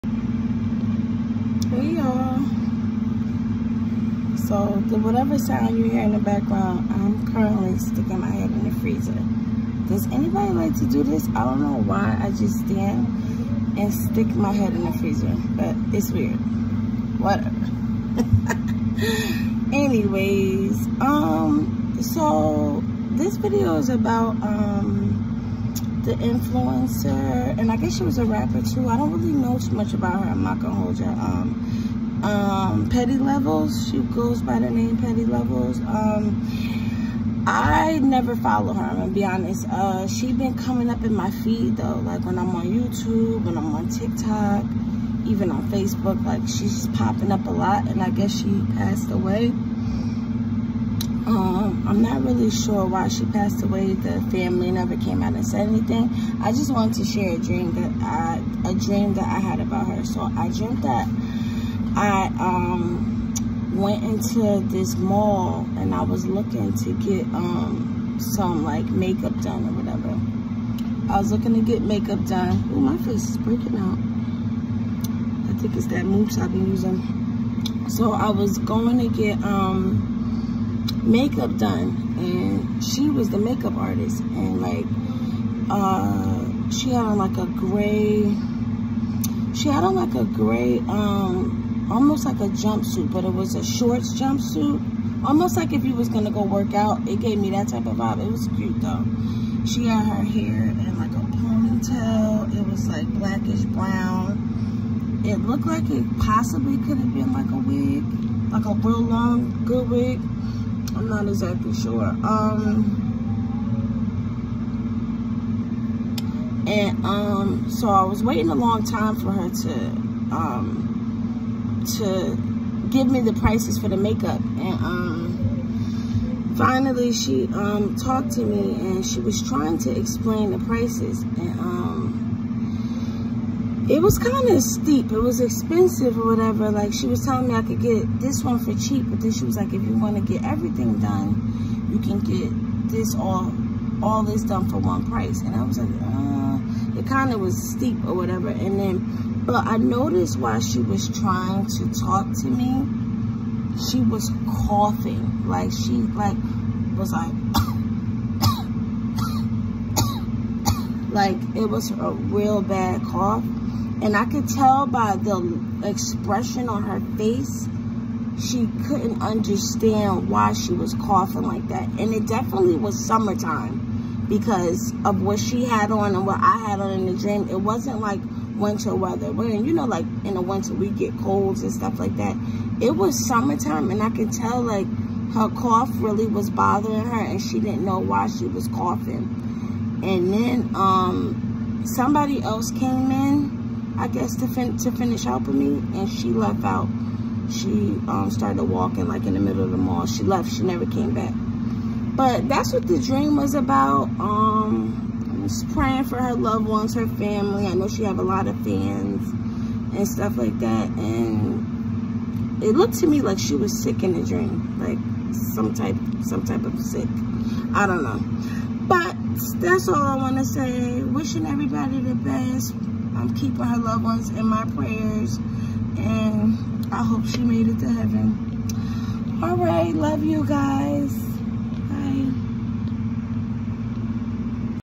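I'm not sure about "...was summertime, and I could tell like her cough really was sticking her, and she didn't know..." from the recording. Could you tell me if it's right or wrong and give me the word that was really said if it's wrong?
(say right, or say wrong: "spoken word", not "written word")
wrong: "bothering", not "sticking".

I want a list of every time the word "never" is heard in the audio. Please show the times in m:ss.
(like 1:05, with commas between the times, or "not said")
0:37, 0:54, 3:20.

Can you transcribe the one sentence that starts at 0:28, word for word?
I don't really know too much about her.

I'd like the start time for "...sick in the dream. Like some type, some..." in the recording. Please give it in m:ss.
3:33.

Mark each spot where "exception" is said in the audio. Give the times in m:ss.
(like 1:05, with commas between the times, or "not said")
not said.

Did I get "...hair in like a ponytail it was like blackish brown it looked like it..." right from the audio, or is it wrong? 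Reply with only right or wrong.
right.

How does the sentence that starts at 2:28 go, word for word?
And then, but I noticed while she was trying to talk to me, she was coughing.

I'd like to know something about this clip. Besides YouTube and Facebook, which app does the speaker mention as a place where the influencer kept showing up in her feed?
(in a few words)
TikTok.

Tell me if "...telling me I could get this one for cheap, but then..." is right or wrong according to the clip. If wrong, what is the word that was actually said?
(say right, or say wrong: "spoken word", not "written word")
right.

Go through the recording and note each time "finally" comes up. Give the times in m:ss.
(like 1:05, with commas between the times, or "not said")
2:06.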